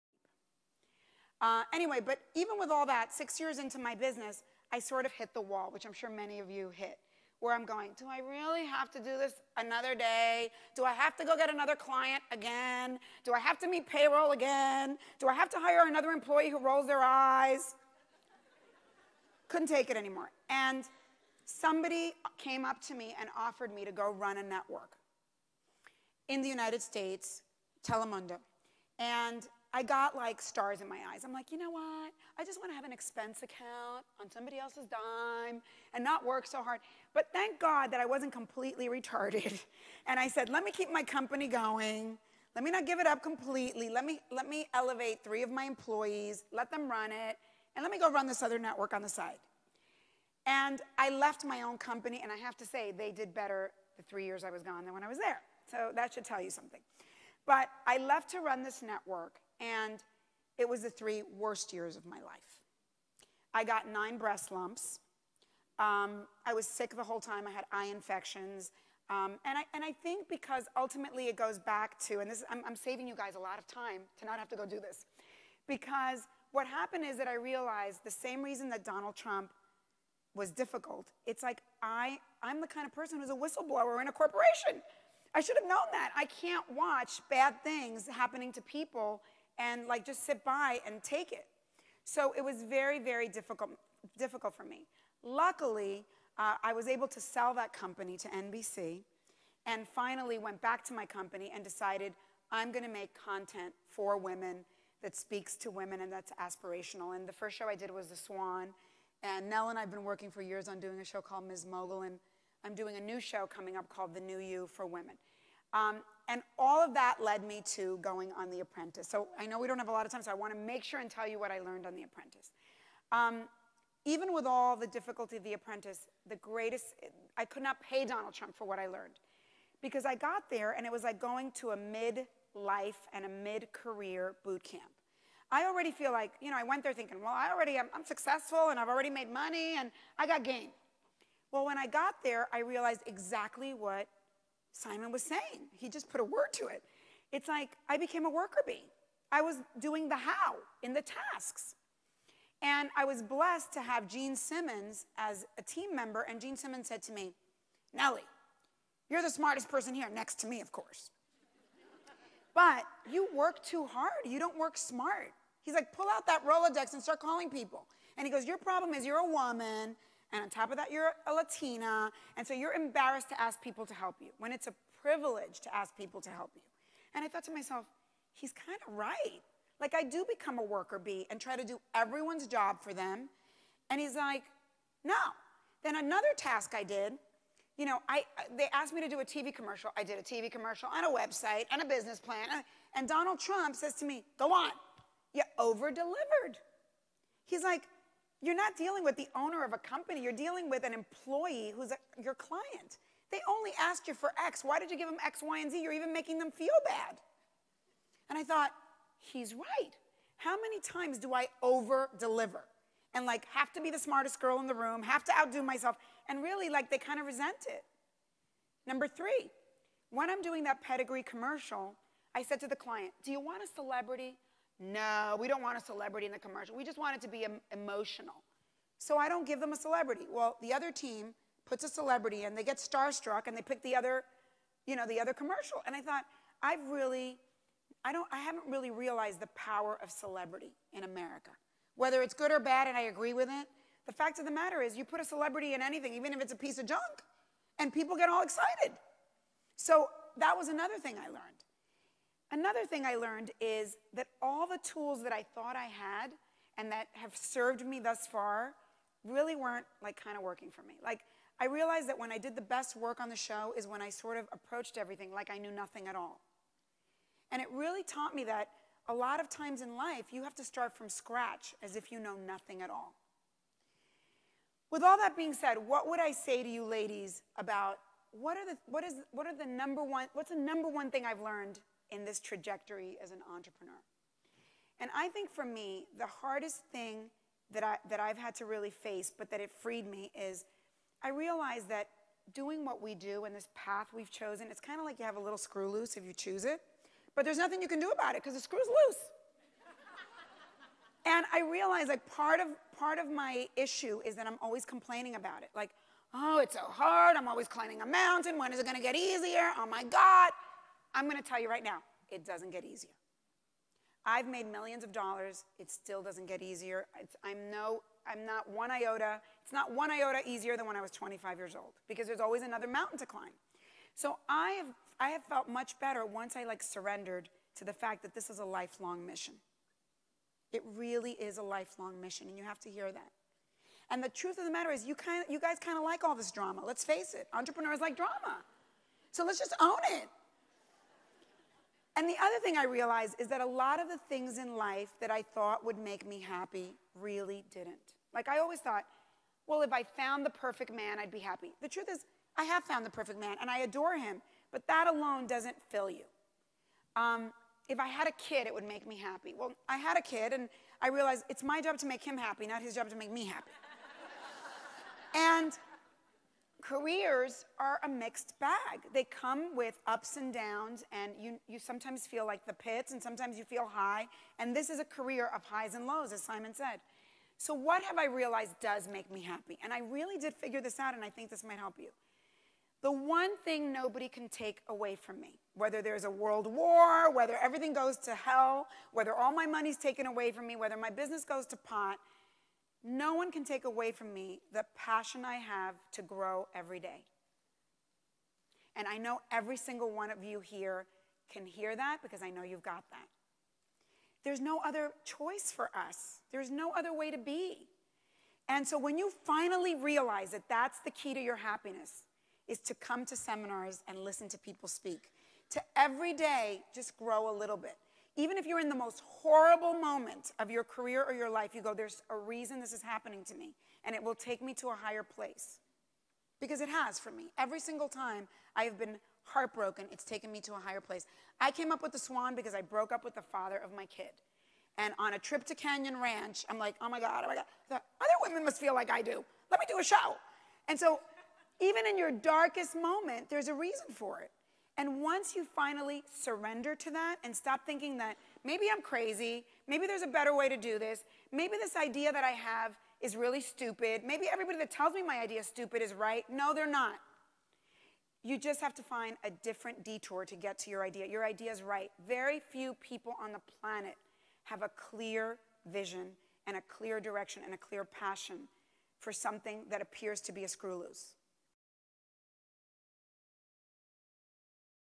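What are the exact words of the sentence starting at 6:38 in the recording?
And I know every single one of you here can hear that because I know you've got that.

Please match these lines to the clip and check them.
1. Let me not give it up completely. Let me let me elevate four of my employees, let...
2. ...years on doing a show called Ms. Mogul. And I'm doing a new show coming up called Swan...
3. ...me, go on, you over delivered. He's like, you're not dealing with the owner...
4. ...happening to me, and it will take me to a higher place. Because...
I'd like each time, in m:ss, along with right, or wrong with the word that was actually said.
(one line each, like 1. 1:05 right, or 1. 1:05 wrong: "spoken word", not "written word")
1. 0:42 wrong: "three", not "four"
2. 1:50 wrong: "The", not "Swan"
3. 3:14 right
4. 7:03 right.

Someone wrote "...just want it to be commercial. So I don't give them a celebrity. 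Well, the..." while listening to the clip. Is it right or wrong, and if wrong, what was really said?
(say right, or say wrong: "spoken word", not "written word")
wrong: "emotional", not "commercial".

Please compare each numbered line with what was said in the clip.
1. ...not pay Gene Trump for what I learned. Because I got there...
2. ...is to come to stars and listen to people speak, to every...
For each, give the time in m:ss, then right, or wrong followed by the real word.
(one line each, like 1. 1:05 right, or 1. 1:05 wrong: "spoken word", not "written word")
1. 2:07 wrong: "Donald", not "Gene"
2. 6:52 wrong: "seminars", not "stars".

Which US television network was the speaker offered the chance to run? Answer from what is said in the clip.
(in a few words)
Telemundo.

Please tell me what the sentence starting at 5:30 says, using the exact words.
It really is a lifelong mission, and you have to hear that.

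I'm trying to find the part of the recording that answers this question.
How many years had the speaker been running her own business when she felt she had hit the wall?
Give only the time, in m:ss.
0:03.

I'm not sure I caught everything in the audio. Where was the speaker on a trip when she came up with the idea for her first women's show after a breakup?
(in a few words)
Canyon Ranch.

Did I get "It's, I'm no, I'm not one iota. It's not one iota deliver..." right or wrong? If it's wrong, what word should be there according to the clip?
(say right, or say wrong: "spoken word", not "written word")
wrong: "easier", not "deliver".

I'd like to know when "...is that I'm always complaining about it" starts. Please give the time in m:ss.
5:04.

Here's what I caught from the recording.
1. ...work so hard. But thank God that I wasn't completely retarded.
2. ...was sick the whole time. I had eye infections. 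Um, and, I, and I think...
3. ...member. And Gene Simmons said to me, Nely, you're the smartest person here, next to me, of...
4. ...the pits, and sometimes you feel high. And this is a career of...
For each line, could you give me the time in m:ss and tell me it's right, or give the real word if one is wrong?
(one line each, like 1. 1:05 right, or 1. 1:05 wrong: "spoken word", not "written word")
1. 0:36 right
2. 1:06 right
3. 2:35 right
4. 6:12 right.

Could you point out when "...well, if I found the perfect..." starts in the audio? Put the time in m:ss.
5:49.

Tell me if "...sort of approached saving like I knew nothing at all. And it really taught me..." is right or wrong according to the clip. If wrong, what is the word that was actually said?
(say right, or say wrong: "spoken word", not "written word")
wrong: "everything", not "saving".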